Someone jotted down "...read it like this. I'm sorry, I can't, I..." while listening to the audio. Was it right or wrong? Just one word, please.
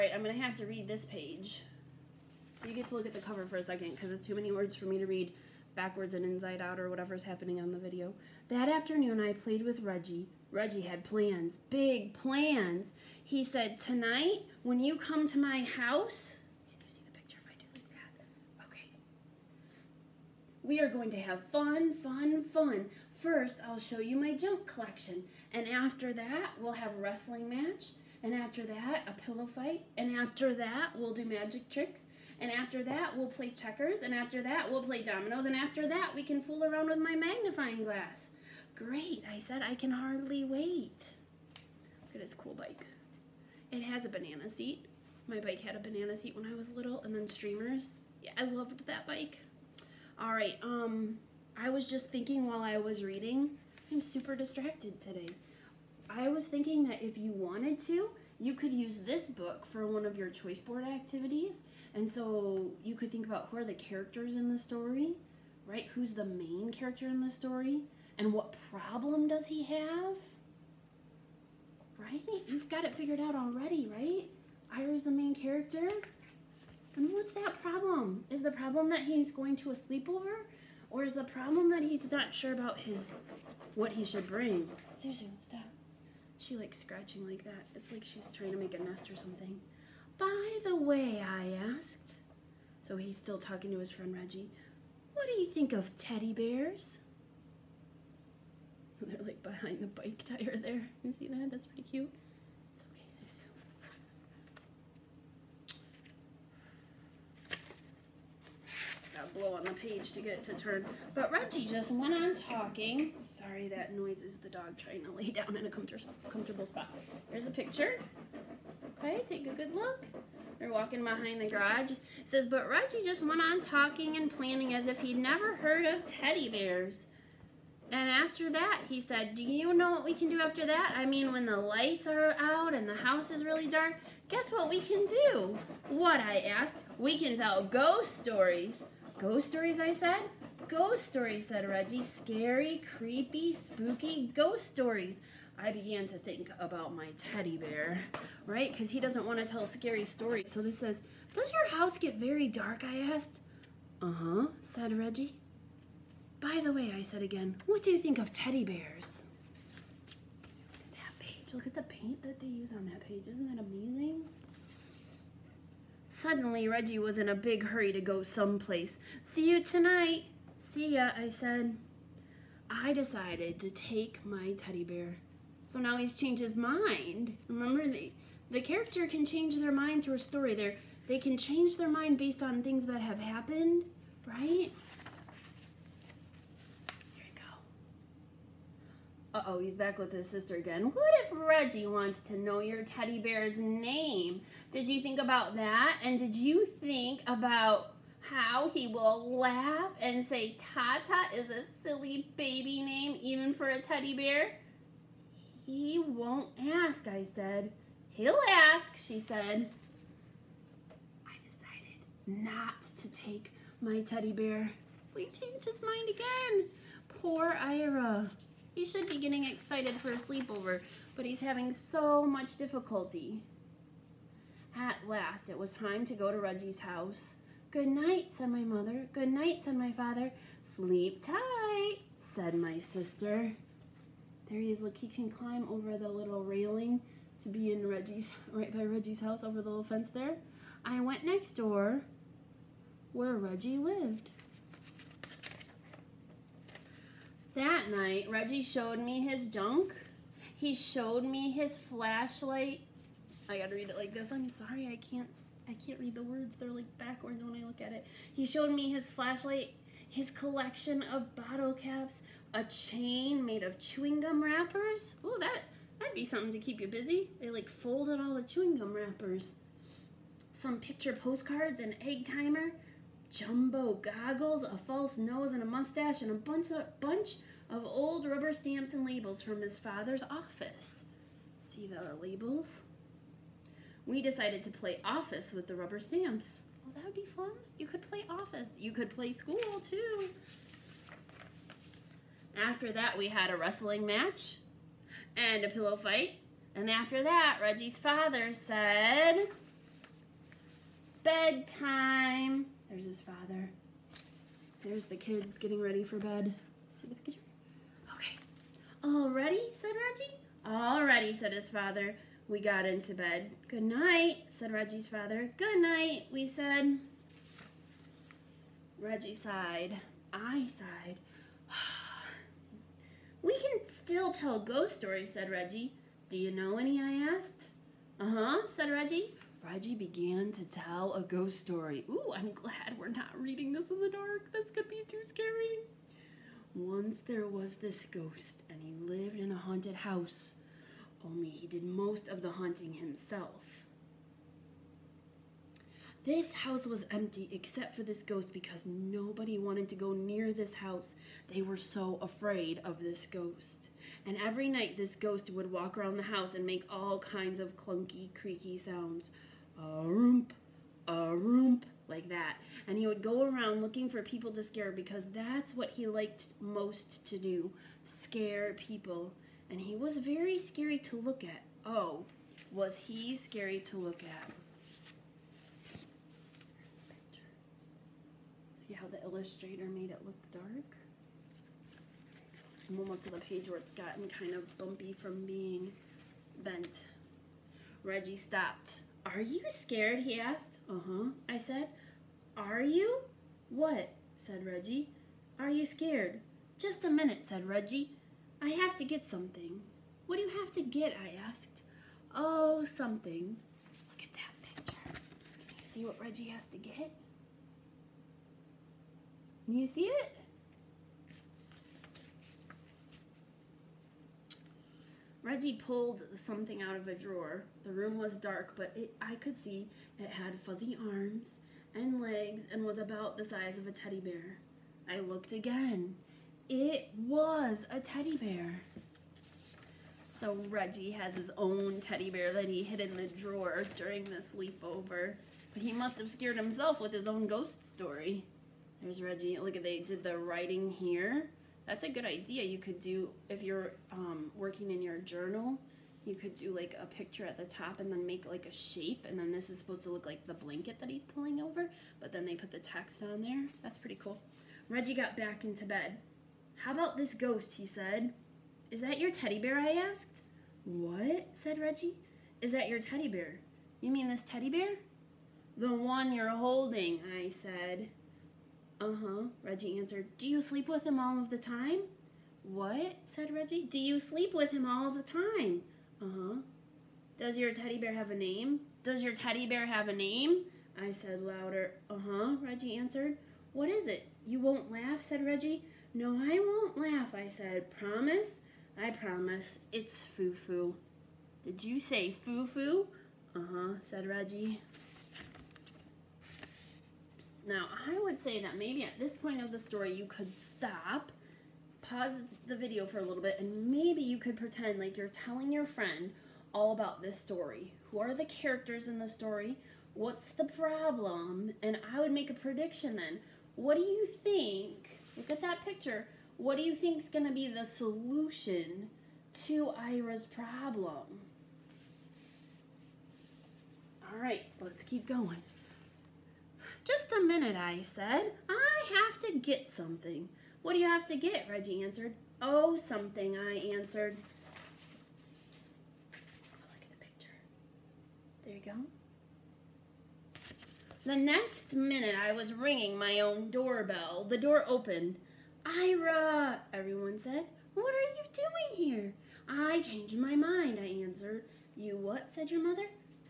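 right.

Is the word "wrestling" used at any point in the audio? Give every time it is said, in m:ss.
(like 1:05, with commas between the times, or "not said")
0:27, 4:53.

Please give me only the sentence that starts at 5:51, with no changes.
They were so afraid of this ghost.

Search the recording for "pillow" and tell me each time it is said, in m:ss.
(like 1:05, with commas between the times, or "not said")
0:29, 4:55.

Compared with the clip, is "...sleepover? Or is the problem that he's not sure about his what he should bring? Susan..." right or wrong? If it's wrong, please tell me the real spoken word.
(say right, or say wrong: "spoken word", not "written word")
right.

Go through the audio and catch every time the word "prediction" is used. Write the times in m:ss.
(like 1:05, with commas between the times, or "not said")
8:32.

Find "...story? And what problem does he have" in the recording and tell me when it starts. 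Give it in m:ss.
1:07.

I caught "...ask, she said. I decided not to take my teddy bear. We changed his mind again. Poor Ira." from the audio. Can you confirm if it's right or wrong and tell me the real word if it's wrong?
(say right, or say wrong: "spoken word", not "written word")
right.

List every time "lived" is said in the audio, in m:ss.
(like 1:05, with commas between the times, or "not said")
4:03, 5:39.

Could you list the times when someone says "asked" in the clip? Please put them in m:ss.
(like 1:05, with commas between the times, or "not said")
1:31, 2:16, 2:33, 5:27, 6:30, 6:41, 7:39.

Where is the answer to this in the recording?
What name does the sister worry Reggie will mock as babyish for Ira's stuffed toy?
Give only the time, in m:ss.
3:20.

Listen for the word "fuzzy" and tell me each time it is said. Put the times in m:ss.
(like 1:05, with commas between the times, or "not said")
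7:00.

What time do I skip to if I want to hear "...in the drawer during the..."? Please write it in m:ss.
7:12.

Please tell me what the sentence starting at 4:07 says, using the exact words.
That night, Reggie showed me his junk.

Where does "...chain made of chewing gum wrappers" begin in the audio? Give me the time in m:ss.
4:22.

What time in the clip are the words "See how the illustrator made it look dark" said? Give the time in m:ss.
6:18.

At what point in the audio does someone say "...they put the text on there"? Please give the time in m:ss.
7:32.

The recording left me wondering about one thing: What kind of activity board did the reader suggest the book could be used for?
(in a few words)
choice board.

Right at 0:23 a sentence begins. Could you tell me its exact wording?
First, I'll show you my junk collection.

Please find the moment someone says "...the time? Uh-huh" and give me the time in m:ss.
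7:55.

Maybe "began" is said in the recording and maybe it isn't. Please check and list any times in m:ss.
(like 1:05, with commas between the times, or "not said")
2:25, 5:29.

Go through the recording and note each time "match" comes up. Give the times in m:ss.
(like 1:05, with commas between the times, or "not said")
0:27, 4:54.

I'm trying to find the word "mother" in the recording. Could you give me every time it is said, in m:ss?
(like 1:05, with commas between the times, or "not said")
3:48, 9:12.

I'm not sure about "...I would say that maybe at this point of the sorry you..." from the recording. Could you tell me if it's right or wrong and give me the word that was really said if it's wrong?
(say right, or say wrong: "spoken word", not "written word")
wrong: "story", not "sorry".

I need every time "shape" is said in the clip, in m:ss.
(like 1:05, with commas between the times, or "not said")
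7:28.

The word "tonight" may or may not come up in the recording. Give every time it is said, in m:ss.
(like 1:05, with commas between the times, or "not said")
0:13, 2:49.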